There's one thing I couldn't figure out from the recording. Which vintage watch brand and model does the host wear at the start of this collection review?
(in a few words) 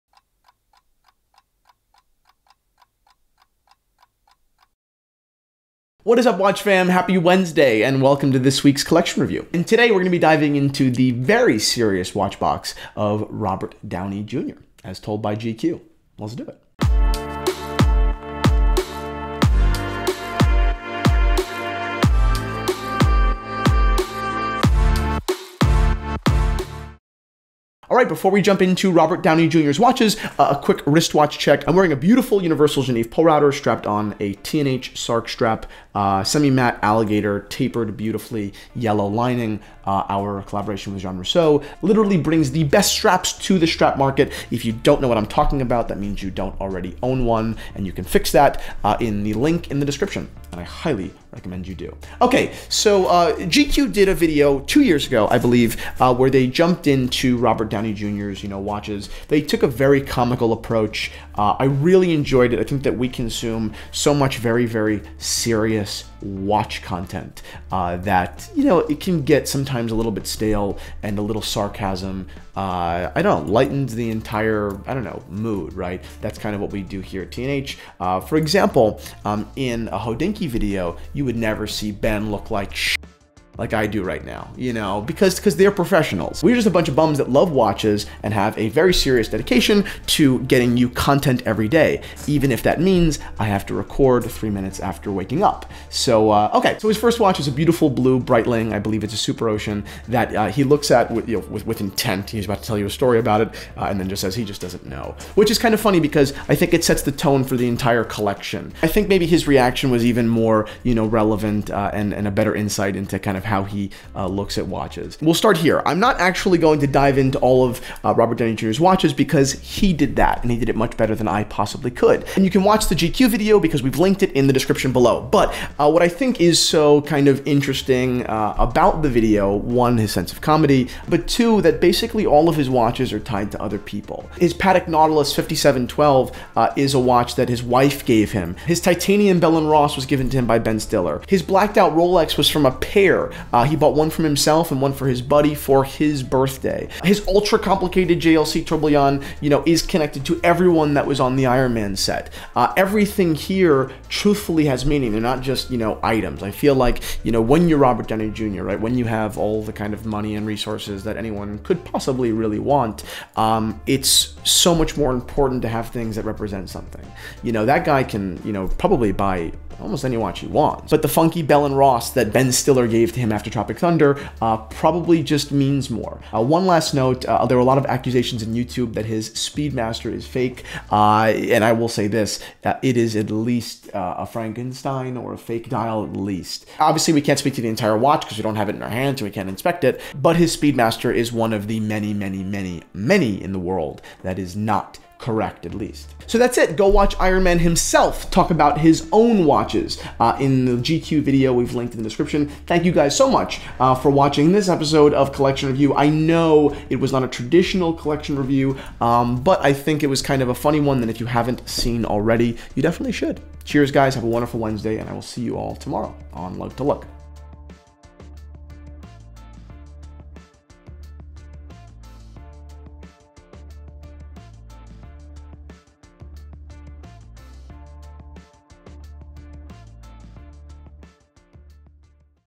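Universal Geneve Polerouter.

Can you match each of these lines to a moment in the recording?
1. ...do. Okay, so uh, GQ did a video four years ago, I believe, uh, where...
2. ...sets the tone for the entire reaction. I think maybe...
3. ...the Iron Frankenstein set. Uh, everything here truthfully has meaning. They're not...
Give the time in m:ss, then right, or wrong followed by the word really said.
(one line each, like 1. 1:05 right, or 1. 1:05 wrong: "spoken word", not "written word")
1. 0:51 wrong: "two", not "four"
2. 1:46 wrong: "collection", not "reaction"
3. 2:31 wrong: "Man", not "Frankenstein".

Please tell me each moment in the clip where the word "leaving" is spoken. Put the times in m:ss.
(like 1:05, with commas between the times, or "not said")
not said.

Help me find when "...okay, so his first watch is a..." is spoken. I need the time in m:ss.
1:36.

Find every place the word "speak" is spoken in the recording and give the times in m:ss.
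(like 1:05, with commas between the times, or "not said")
3:07.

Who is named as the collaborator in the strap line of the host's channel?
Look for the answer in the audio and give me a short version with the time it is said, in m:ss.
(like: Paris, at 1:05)
Jean Rousseau, at 0:41.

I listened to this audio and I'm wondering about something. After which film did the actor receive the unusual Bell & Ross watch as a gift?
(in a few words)
Tropic Thunder.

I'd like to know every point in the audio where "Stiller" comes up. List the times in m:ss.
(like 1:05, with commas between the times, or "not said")
2:20, 2:52.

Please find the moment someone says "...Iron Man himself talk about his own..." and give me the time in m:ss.
3:17.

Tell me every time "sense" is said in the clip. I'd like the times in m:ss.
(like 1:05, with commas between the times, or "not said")
2:10.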